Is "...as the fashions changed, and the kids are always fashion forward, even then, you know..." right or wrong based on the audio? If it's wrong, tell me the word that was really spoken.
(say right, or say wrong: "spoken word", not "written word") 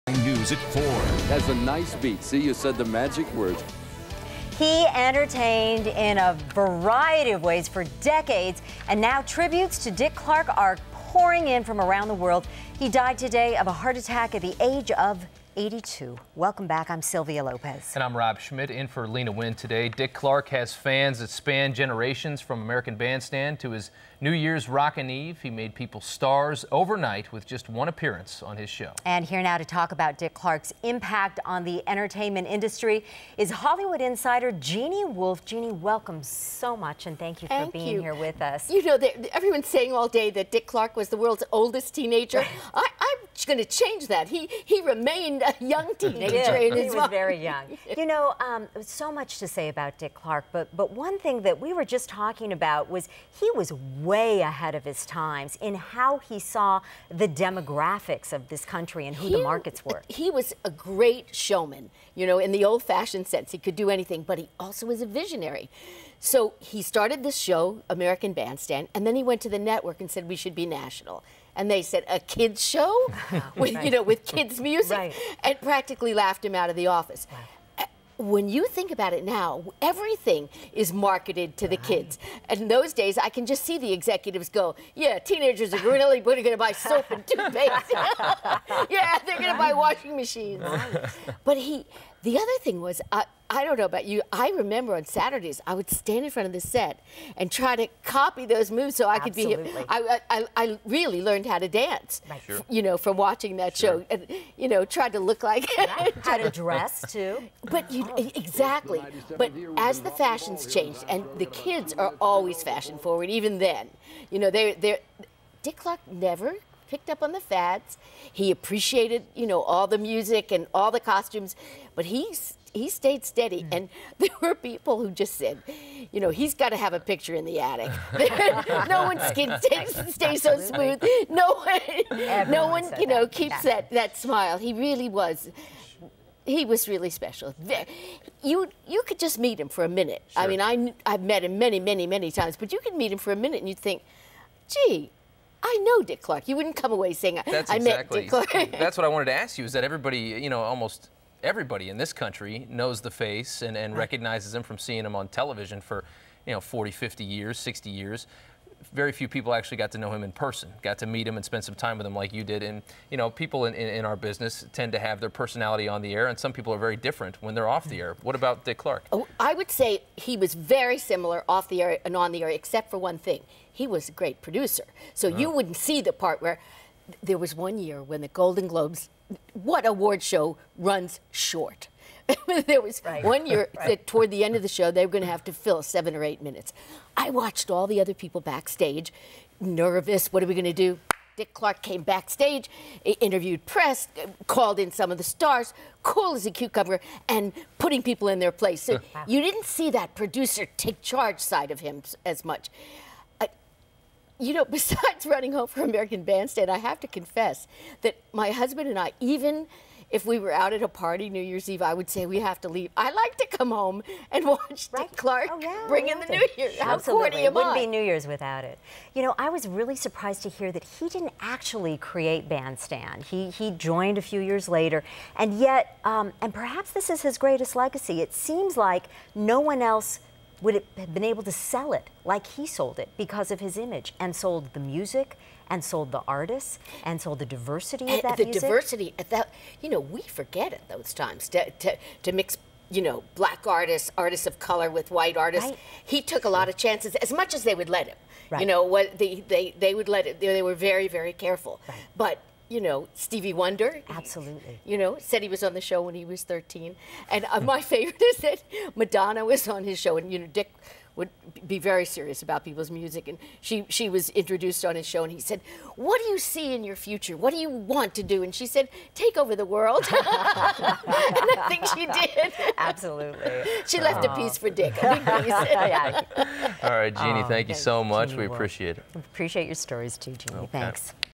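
right.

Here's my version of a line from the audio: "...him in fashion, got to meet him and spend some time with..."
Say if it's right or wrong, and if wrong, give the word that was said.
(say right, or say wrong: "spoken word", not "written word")
wrong: "person", not "fashion".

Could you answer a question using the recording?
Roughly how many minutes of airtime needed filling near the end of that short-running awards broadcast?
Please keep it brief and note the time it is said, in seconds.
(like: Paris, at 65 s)
7 or 8 minutes, at 185 s.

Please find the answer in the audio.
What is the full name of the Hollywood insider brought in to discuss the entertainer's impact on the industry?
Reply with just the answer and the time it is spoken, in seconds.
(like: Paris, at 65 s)
Jeanne Wolf, at 34 s.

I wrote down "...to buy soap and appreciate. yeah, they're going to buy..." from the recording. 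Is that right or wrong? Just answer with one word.
wrong.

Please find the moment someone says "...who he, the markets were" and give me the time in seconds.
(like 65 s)
59 s.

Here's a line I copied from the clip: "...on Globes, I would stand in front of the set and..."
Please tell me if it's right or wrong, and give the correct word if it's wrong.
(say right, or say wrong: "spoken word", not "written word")
wrong: "Saturdays", not "Globes".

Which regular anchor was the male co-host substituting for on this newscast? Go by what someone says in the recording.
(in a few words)
Lena Wynn.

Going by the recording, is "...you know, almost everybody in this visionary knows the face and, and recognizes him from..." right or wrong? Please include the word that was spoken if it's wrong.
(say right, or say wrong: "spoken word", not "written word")
wrong: "country", not "visionary".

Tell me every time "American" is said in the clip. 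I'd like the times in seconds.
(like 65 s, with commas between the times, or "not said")
22 s, 67 s, 205 s.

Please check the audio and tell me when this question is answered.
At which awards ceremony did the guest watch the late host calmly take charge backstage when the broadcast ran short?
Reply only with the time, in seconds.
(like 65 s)
178 s.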